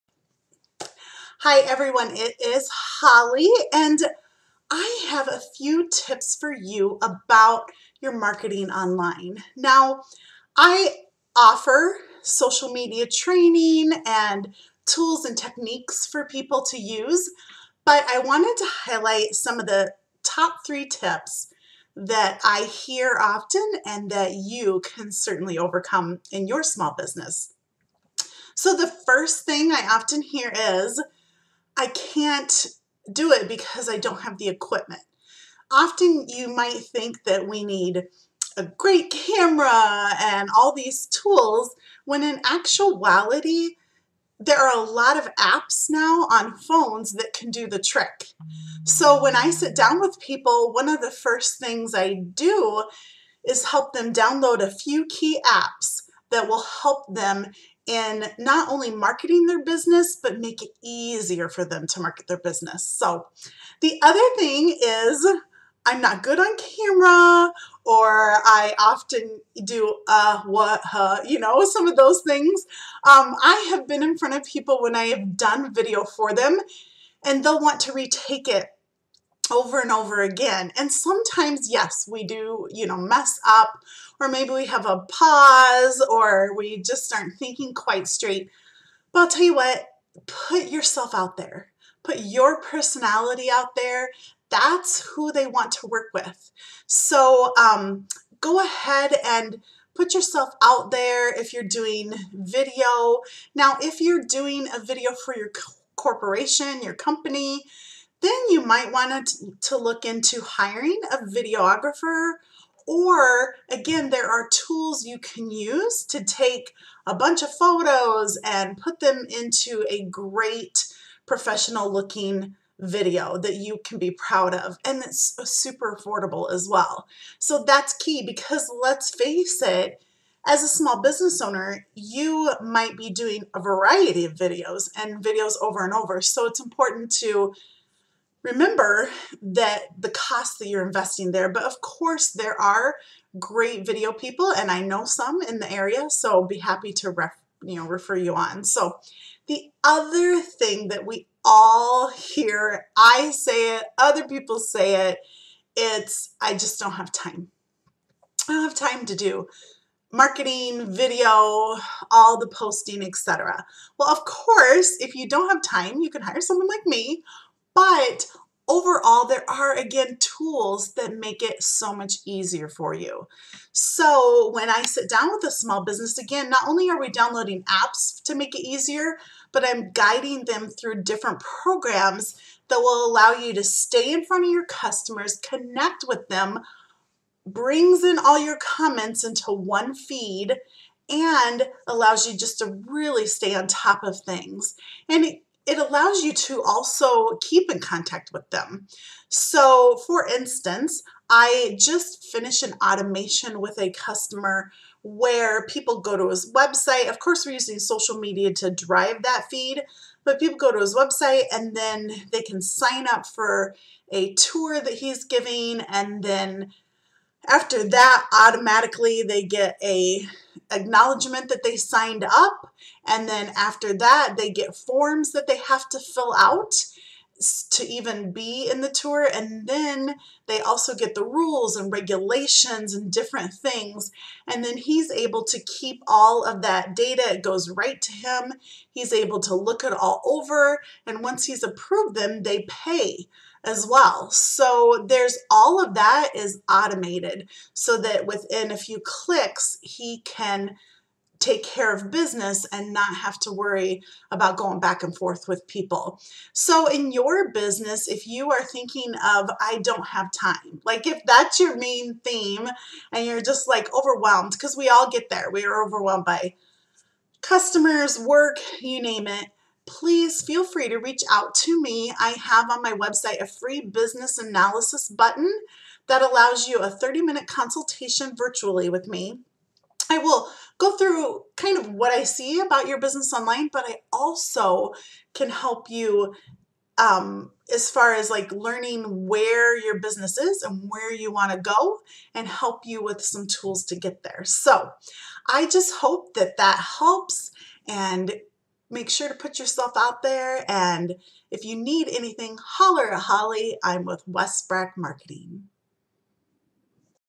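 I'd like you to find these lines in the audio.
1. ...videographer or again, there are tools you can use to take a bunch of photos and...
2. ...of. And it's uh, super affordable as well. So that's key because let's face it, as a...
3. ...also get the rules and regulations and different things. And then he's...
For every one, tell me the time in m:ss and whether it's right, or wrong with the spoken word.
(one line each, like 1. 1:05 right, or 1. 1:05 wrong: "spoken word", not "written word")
1. 1:51 right
2. 2:04 right
3. 3:50 right.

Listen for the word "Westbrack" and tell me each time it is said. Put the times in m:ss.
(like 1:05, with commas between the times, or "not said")
5:04.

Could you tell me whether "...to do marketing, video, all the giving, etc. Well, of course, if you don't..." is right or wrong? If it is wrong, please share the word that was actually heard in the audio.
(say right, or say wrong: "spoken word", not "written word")
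wrong: "posting", not "giving".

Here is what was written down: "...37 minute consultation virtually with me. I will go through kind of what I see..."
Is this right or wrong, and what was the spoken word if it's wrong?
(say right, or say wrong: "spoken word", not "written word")
wrong: "30", not "37".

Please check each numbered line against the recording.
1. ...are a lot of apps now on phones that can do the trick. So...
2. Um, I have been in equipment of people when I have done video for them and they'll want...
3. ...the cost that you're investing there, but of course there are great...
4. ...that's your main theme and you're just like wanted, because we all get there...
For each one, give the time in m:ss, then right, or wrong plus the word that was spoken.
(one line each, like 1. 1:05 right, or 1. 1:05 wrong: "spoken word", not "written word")
1. 0:44 right
2. 1:13 wrong: "front", not "equipment"
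3. 2:19 right
4. 4:21 wrong: "overwhelmed", not "wanted".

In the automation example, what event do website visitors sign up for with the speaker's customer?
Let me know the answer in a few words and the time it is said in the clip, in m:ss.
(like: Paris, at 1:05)
A tour, at 3:34.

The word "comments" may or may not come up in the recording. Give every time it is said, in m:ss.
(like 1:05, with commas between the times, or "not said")
3:08.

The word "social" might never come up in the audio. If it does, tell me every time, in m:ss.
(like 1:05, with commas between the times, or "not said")
0:12, 3:27.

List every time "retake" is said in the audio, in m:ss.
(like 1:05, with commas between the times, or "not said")
1:17.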